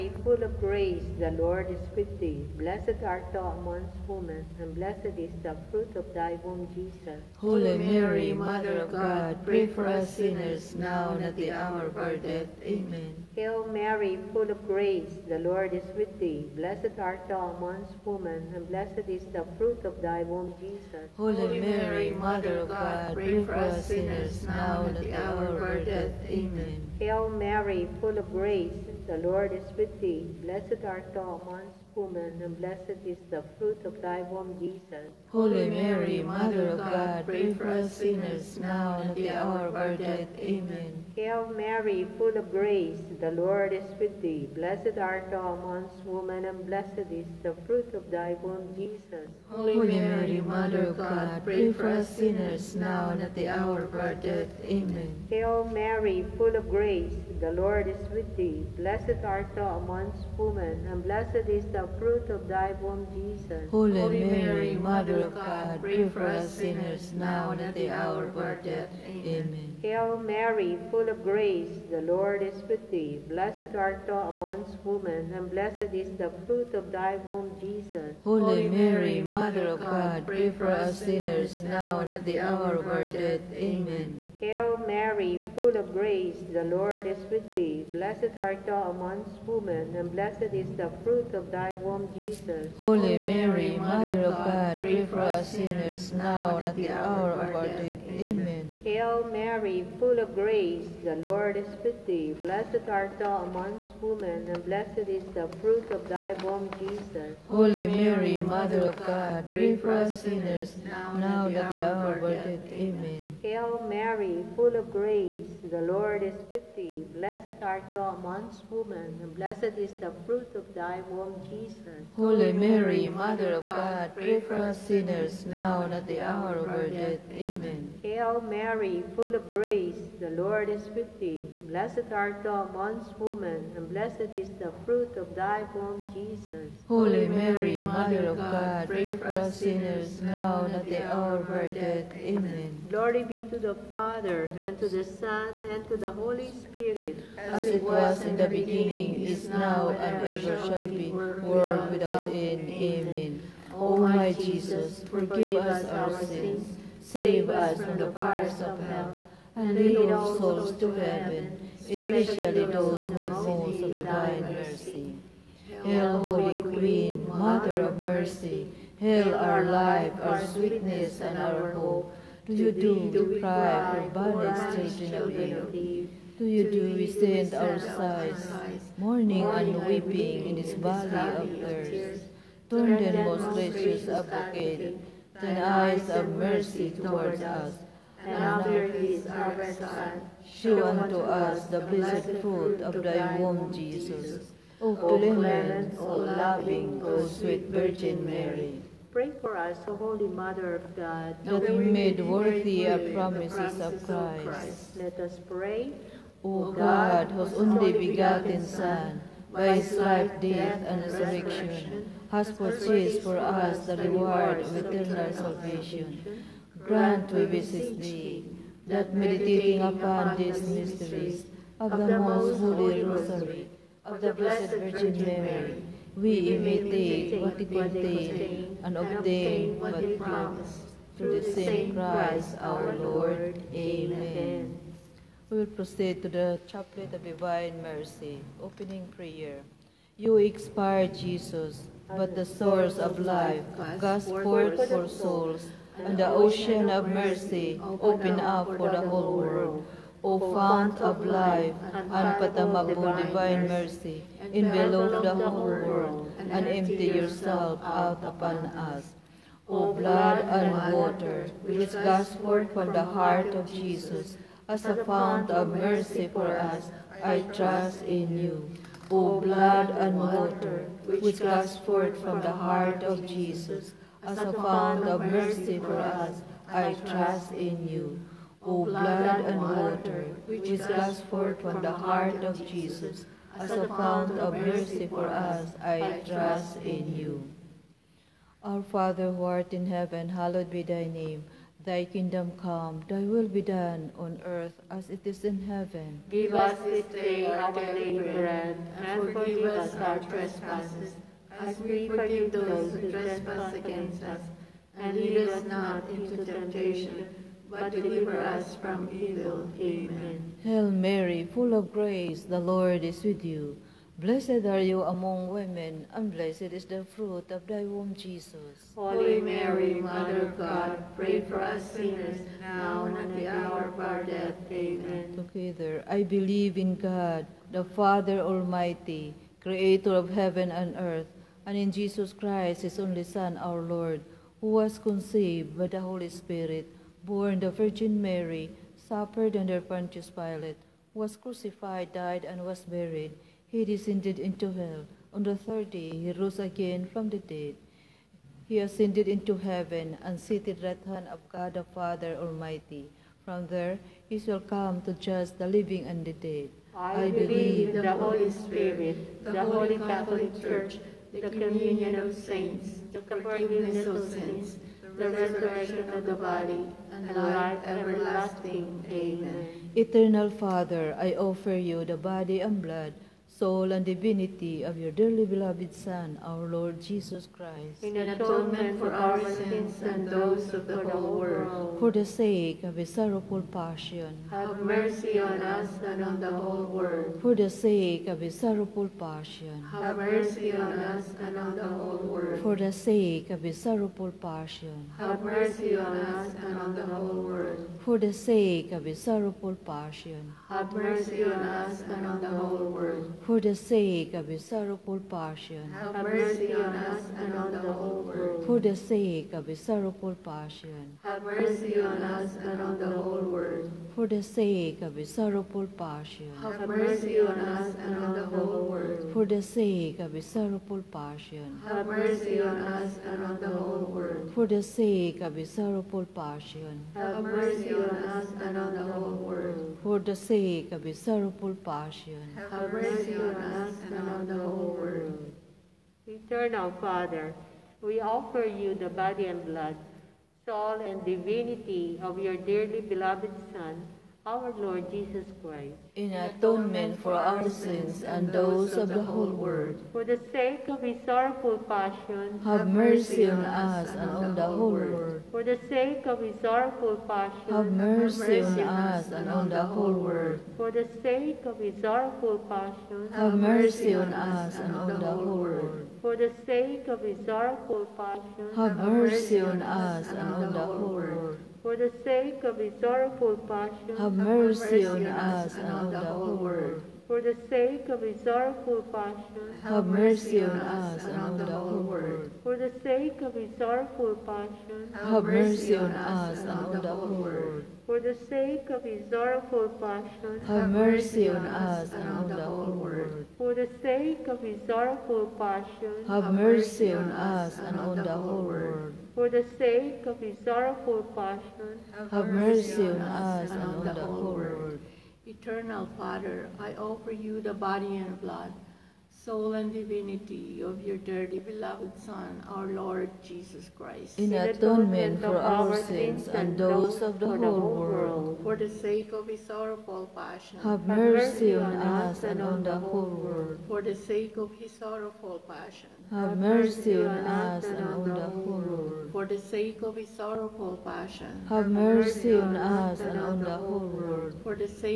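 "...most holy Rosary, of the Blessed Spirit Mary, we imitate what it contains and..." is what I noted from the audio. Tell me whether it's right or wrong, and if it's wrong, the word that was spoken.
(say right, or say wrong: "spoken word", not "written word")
wrong: "Virgin", not "Spirit".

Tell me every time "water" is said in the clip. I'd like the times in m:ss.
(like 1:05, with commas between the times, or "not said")
4:20, 4:30, 4:39.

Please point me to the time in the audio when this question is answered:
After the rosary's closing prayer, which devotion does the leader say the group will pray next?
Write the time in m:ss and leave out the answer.
3:56.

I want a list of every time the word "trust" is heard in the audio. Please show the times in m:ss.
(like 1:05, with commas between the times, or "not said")
4:27, 4:37, 4:46.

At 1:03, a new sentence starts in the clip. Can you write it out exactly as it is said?
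Holy, Holy Mary, Mary, Mother of God, pray for us sinners now and at the hour of our death.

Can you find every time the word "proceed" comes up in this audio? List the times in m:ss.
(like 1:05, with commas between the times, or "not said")
3:55.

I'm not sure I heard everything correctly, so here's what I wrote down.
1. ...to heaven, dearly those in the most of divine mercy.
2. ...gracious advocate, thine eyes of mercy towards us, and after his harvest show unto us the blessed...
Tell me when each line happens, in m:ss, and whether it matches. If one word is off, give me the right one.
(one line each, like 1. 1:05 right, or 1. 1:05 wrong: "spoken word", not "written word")
1. 2:40 wrong: "especially", not "dearly"
2. 3:03 right.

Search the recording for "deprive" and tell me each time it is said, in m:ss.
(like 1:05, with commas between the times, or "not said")
2:53.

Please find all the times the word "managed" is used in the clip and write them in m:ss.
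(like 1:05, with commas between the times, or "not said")
not said.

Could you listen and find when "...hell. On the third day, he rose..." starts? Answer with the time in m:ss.
5:44.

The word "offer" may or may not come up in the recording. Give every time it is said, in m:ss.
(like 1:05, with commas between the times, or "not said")
6:11, 7:18, 8:26.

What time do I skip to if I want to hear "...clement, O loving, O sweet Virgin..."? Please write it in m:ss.
3:14.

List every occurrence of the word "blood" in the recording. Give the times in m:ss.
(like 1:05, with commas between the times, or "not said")
4:19, 4:29, 4:38, 6:12, 7:19, 8:28.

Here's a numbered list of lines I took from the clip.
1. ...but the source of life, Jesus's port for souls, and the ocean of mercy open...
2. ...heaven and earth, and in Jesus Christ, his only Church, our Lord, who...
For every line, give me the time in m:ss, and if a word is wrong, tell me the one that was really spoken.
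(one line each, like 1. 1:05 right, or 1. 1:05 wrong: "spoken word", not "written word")
1. 4:02 wrong: "God", not "Jesus"
2. 5:30 wrong: "Son", not "Church".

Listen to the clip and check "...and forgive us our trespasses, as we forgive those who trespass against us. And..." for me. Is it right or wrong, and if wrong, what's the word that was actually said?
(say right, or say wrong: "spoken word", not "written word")
right.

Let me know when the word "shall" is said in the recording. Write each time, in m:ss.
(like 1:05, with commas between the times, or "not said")
2:30, 5:54.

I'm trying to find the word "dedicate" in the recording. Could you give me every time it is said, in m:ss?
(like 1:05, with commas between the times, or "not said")
not said.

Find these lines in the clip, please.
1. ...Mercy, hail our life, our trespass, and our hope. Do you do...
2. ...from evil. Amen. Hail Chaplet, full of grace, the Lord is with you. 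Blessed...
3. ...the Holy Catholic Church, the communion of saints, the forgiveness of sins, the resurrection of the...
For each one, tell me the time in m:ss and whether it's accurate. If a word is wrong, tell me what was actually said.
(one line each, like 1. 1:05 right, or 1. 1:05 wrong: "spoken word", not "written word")
1. 2:47 wrong: "sweetness", not "trespass"
2. 5:08 wrong: "Mary", not "Chaplet"
3. 5:59 right.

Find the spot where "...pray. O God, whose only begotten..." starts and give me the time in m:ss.
3:25.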